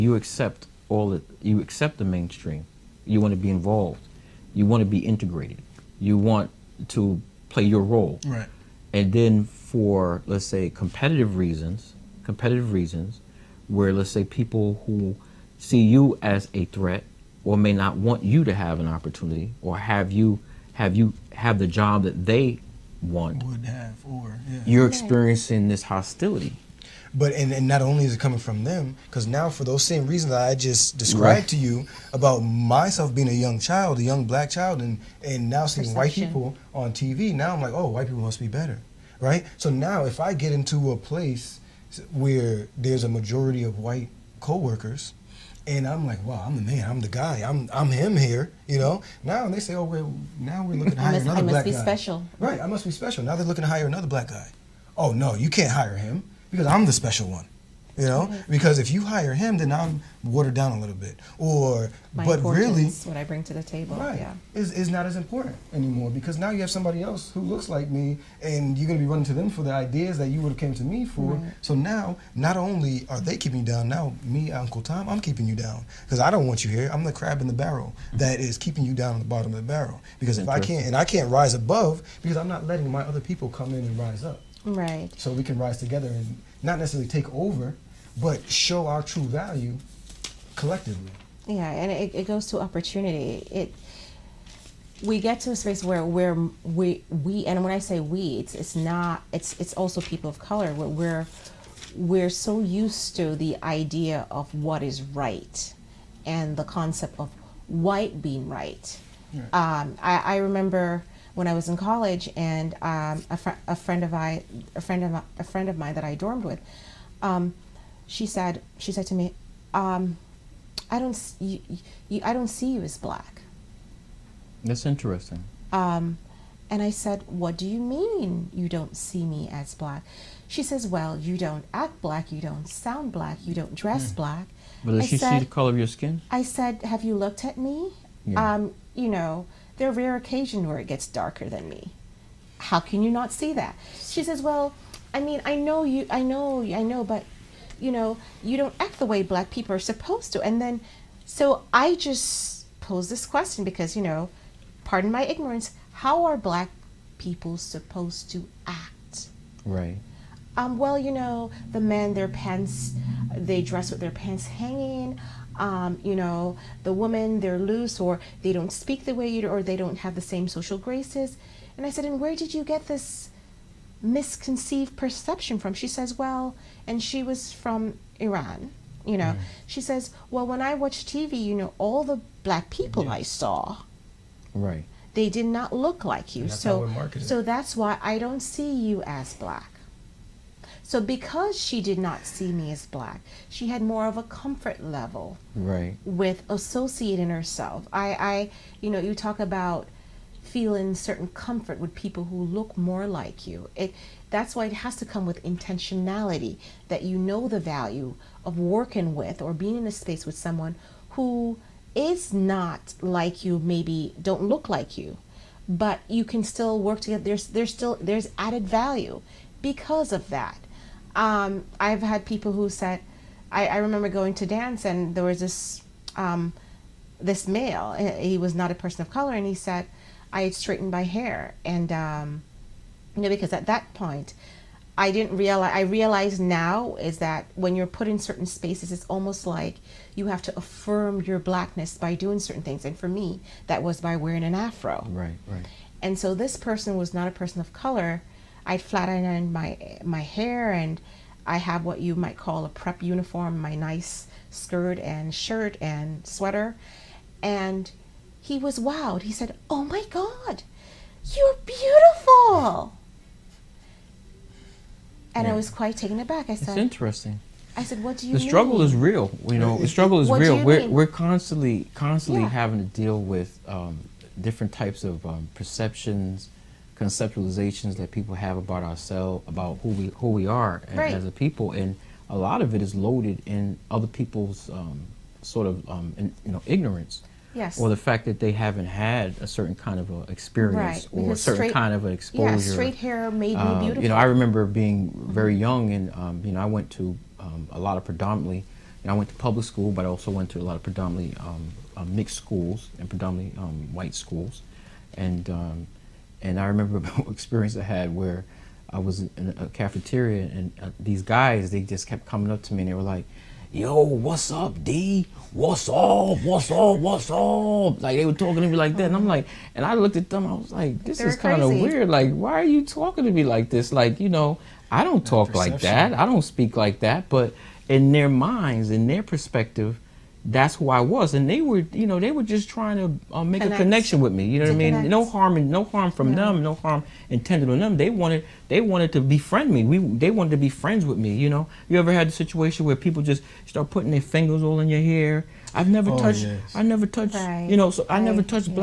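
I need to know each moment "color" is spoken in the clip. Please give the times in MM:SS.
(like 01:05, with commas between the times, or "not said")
01:40, 02:15, 03:49, 04:07.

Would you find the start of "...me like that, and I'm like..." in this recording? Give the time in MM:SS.
05:18.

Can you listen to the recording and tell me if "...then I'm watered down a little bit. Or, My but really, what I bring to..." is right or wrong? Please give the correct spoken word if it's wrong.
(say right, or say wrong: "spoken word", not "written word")
right.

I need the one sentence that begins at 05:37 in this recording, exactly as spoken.
They wanted, they wanted to befriend me.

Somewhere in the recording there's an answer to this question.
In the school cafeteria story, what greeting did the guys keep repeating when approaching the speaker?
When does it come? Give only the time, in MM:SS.
05:14.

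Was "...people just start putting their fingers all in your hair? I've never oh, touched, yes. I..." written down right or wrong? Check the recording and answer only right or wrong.
right.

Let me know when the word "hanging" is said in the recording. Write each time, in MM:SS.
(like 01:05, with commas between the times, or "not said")
02:44.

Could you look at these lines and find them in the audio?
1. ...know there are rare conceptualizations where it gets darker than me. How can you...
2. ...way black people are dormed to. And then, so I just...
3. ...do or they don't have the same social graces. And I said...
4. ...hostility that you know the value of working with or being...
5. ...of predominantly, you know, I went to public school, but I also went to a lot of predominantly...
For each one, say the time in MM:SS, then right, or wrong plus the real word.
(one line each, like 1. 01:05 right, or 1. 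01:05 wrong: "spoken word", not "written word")
1. 02:19 wrong: "occasions", not "conceptualizations"
2. 02:29 wrong: "supposed", not "dormed"
3. 02:49 right
4. 03:25 wrong: "intentionality", not "hostility"
5. 04:57 right.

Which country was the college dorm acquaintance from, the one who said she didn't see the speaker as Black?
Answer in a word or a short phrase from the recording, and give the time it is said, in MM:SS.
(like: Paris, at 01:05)
Iran, at 02:58.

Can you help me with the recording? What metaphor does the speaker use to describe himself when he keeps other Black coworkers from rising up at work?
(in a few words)
crab in the barrel.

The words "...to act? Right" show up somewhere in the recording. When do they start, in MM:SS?
02:38.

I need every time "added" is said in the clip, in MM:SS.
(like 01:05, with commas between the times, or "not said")
03:38.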